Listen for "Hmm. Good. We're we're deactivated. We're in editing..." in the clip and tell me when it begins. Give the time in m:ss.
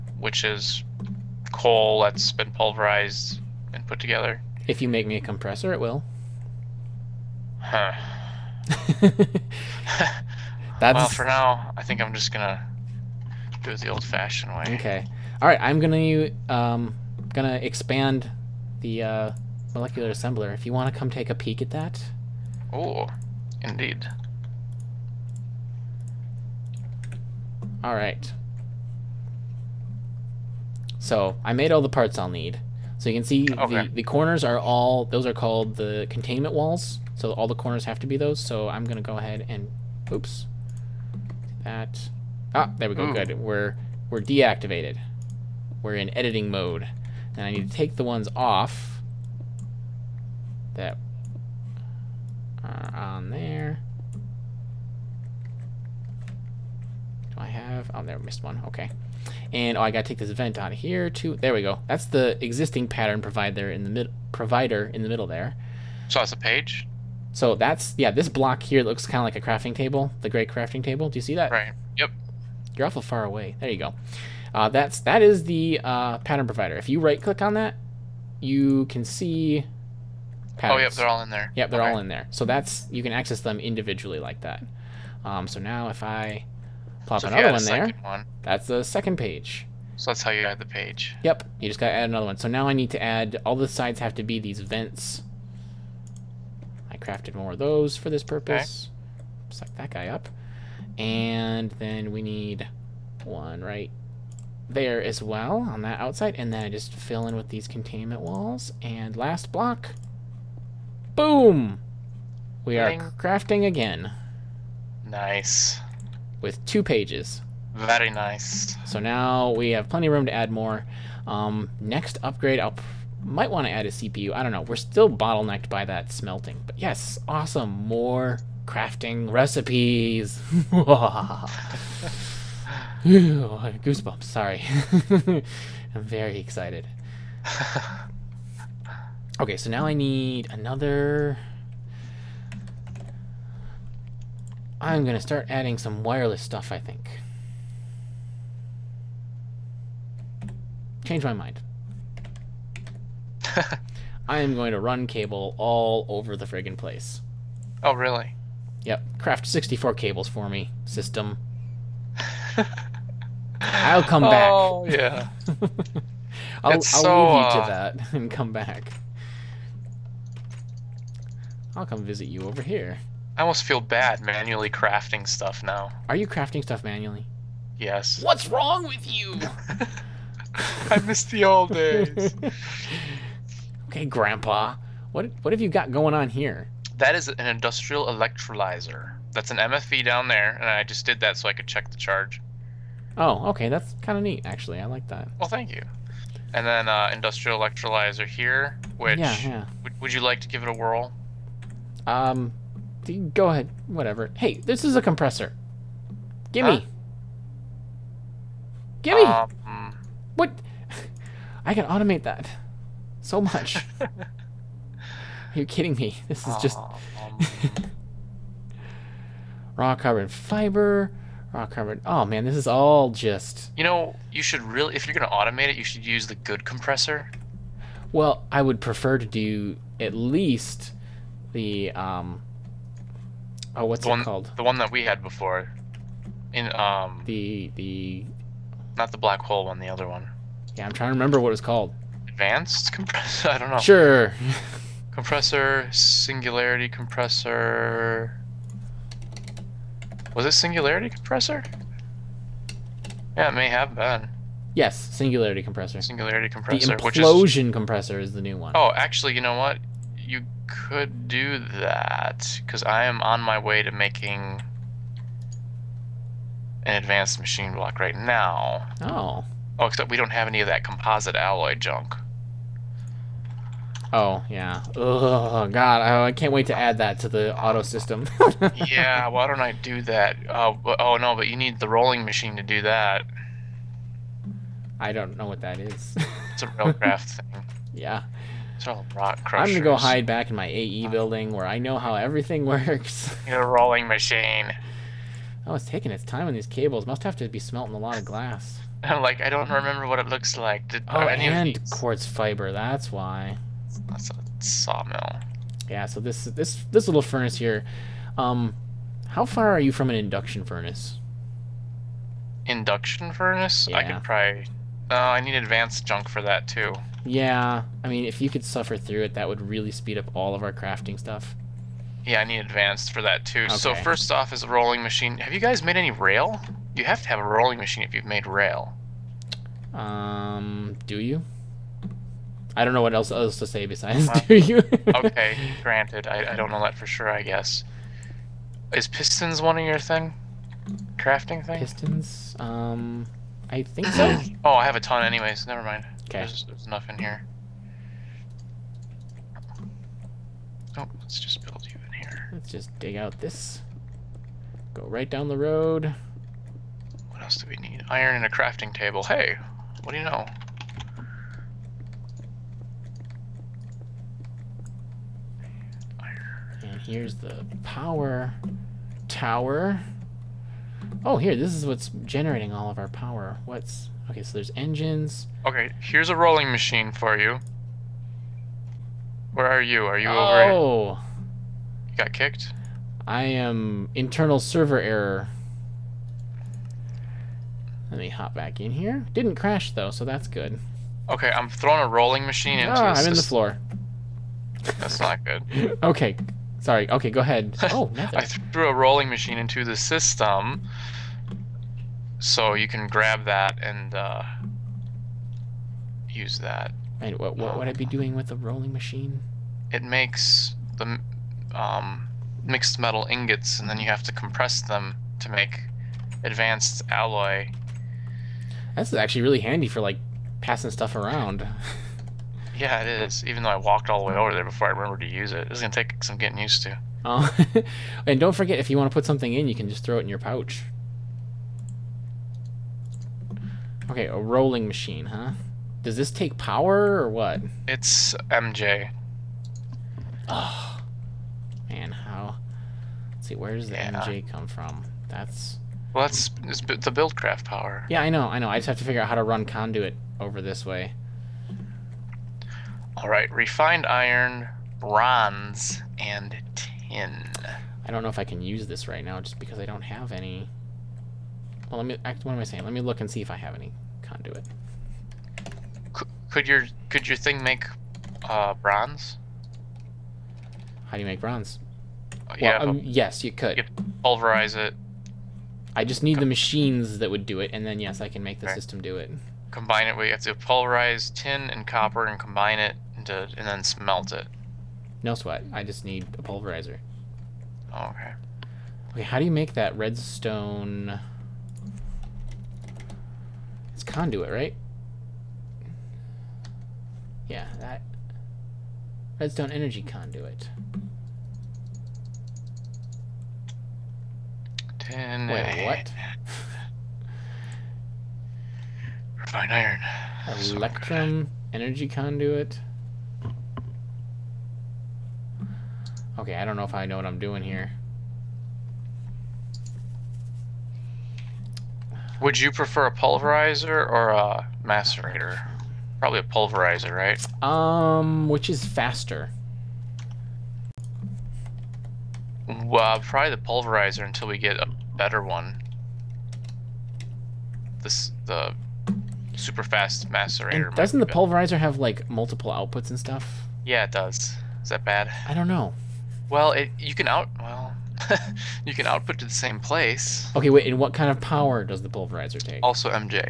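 0:43.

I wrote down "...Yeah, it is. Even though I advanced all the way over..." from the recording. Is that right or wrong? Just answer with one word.
wrong.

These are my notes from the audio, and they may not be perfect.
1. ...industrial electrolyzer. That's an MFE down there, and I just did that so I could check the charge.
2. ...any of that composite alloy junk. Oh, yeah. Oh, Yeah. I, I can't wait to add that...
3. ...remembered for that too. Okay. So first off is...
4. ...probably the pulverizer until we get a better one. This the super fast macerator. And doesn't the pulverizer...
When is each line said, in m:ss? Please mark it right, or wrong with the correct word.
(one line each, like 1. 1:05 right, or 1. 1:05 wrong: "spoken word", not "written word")
1. 3:07 right
2. 4:30 wrong: "God", not "Yeah"
3. 5:22 wrong: "advanced", not "remembered"
4. 8:53 right.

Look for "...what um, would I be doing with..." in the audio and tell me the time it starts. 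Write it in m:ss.
6:47.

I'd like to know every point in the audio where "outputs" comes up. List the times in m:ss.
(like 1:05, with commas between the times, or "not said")
9:02, 9:09.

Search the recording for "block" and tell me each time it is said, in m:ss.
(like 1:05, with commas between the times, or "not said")
1:08, 1:49, 4:27.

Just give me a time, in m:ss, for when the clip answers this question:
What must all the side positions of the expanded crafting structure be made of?
1:34.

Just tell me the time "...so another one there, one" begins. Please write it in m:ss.
1:27.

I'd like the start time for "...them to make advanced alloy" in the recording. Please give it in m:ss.
6:54.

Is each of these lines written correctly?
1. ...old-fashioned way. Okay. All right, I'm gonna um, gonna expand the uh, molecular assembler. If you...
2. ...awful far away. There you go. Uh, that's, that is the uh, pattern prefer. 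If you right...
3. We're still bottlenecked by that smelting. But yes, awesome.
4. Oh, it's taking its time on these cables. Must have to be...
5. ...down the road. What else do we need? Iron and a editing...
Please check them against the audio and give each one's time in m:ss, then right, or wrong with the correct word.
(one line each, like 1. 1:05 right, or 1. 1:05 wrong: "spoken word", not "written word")
1. 0:13 right
2. 1:12 wrong: "provider", not "prefer"
3. 2:04 right
4. 4:55 right
5. 5:55 wrong: "crafting", not "editing".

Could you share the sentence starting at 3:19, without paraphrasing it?
Would, would you like to give it a whirl?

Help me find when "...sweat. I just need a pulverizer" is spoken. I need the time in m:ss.
8:05.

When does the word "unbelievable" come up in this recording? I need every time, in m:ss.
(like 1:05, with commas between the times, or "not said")
not said.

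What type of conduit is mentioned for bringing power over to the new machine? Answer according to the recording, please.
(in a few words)
Redstone energy conduit.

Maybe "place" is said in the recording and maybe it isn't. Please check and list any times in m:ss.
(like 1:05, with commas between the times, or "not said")
2:36, 9:09.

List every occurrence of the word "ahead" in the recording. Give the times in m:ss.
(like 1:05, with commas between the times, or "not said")
0:39, 3:23, 6:37.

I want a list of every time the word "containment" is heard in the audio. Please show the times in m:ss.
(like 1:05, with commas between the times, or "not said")
0:36, 1:47.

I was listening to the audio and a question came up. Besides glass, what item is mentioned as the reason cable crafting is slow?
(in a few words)
Quartz fiber.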